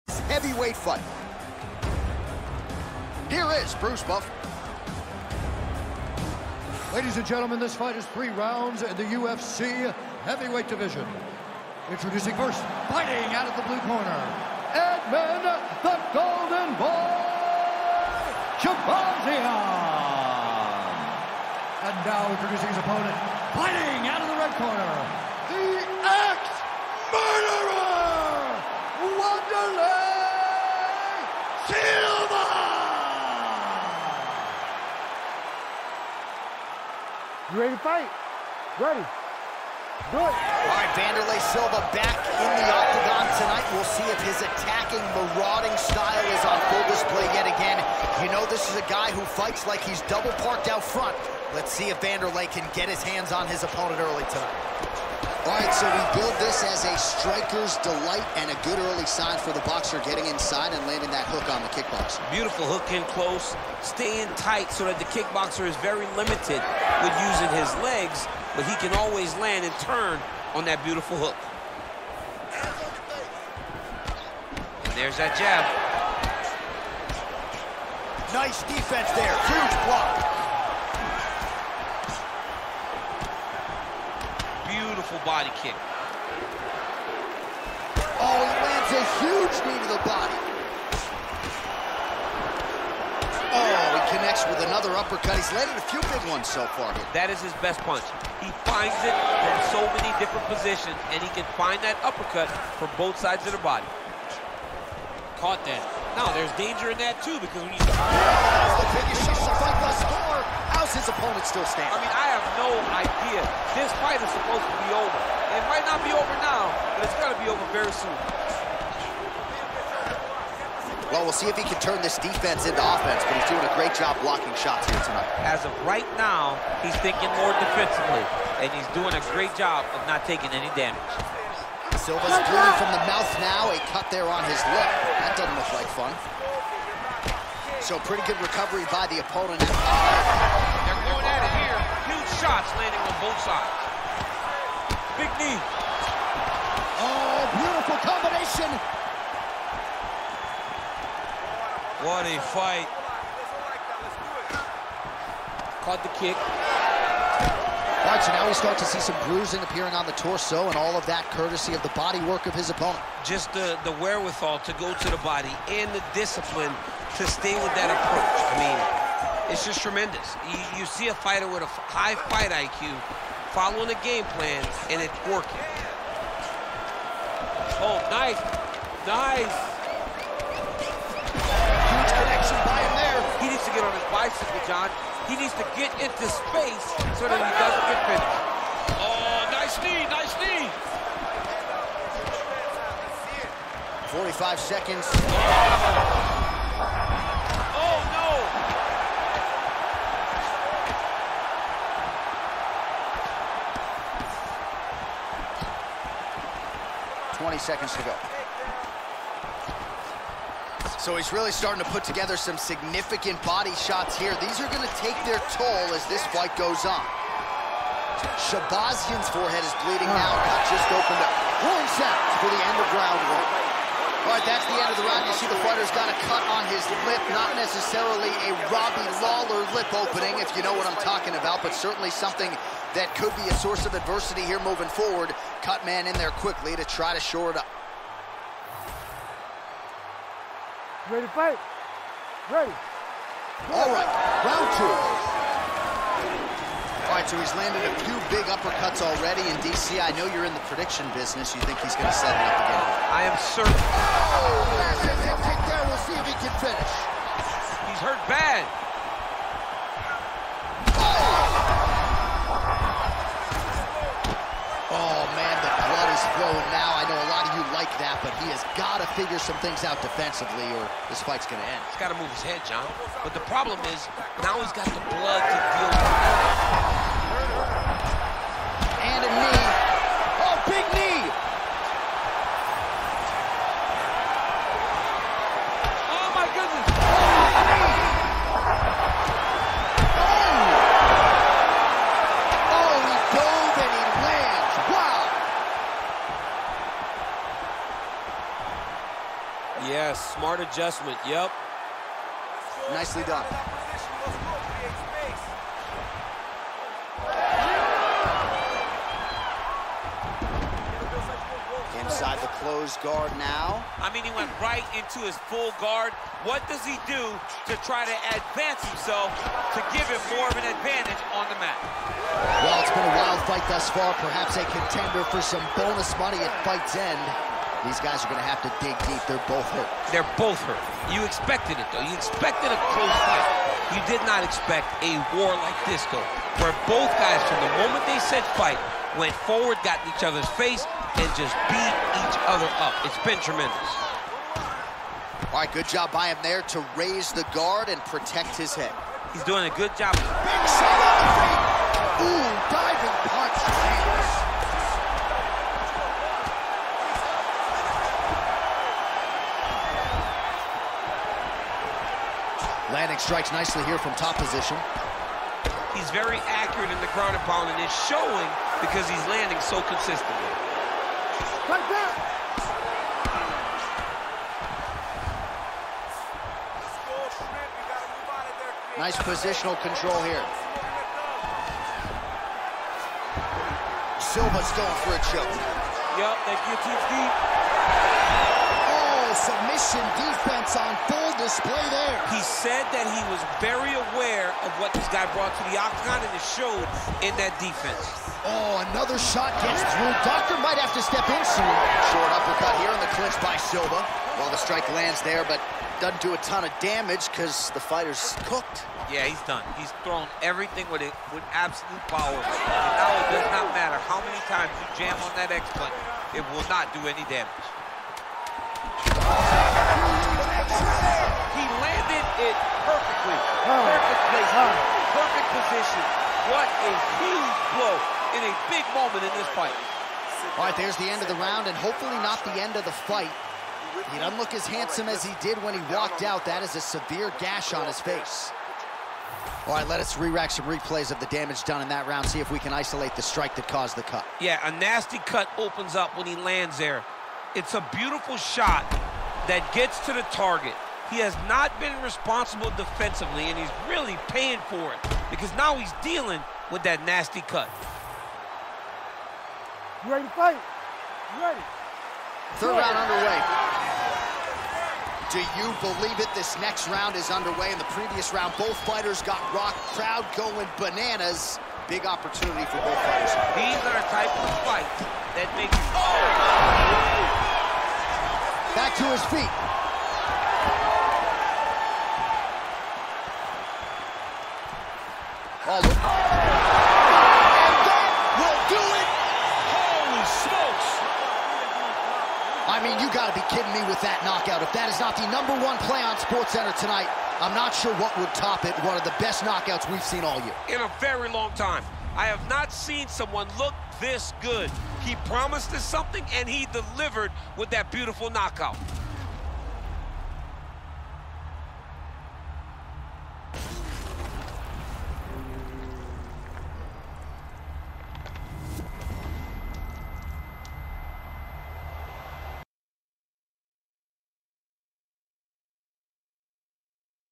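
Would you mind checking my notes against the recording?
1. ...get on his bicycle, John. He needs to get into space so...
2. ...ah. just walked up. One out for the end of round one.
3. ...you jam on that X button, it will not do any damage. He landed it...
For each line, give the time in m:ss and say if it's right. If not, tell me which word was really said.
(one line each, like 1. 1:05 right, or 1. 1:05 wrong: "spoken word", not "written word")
1. 3:03 right
2. 3:40 wrong: "opened", not "walked"
3. 6:54 right.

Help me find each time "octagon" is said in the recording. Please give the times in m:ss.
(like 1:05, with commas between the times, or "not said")
0:42, 6:35.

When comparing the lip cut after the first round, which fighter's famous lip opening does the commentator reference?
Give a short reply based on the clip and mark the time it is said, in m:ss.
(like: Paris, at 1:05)
Robbie Lawler, at 3:48.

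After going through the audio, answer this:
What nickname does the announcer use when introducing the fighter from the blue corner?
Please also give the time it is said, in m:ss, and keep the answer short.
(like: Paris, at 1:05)
The Golden Boy, at 0:15.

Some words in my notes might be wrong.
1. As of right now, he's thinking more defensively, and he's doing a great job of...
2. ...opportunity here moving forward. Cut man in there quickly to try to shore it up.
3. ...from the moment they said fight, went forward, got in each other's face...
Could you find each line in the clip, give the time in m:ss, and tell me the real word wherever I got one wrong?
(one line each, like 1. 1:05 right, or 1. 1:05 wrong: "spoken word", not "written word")
1. 2:05 right
2. 3:53 wrong: "adversity", not "opportunity"
3. 5:37 right.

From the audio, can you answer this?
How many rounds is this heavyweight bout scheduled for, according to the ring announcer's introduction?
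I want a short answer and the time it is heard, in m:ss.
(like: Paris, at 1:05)
3, at 0:08.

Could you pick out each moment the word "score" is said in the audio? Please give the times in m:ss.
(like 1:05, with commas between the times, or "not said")
1:49.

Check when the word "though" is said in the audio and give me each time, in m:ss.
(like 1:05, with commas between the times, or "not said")
5:31, 5:36.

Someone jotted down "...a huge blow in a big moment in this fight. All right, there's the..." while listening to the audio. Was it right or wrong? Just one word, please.
right.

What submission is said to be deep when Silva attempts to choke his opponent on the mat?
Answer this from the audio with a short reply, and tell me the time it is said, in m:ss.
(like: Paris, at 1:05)
Guillotine, at 6:26.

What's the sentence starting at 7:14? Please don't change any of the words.
He doesn't look as handsome as he did when he walked out.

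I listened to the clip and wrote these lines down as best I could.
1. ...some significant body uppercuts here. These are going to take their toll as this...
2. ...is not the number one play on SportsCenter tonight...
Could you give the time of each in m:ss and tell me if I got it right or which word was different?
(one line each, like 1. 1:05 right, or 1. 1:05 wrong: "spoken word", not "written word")
1. 3:32 wrong: "shots", not "uppercuts"
2. 8:14 right.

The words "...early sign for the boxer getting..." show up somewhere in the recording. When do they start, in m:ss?
0:58.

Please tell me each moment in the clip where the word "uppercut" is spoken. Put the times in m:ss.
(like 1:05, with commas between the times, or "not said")
1:34, 1:42, 4:08, 6:42.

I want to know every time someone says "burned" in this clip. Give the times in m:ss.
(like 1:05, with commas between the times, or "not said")
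not said.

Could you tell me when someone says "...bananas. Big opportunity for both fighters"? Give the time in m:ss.
7:50.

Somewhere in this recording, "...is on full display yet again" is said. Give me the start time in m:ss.
0:46.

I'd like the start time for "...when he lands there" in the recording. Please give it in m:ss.
7:26.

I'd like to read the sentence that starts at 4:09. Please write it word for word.
I know you're in the prediction business.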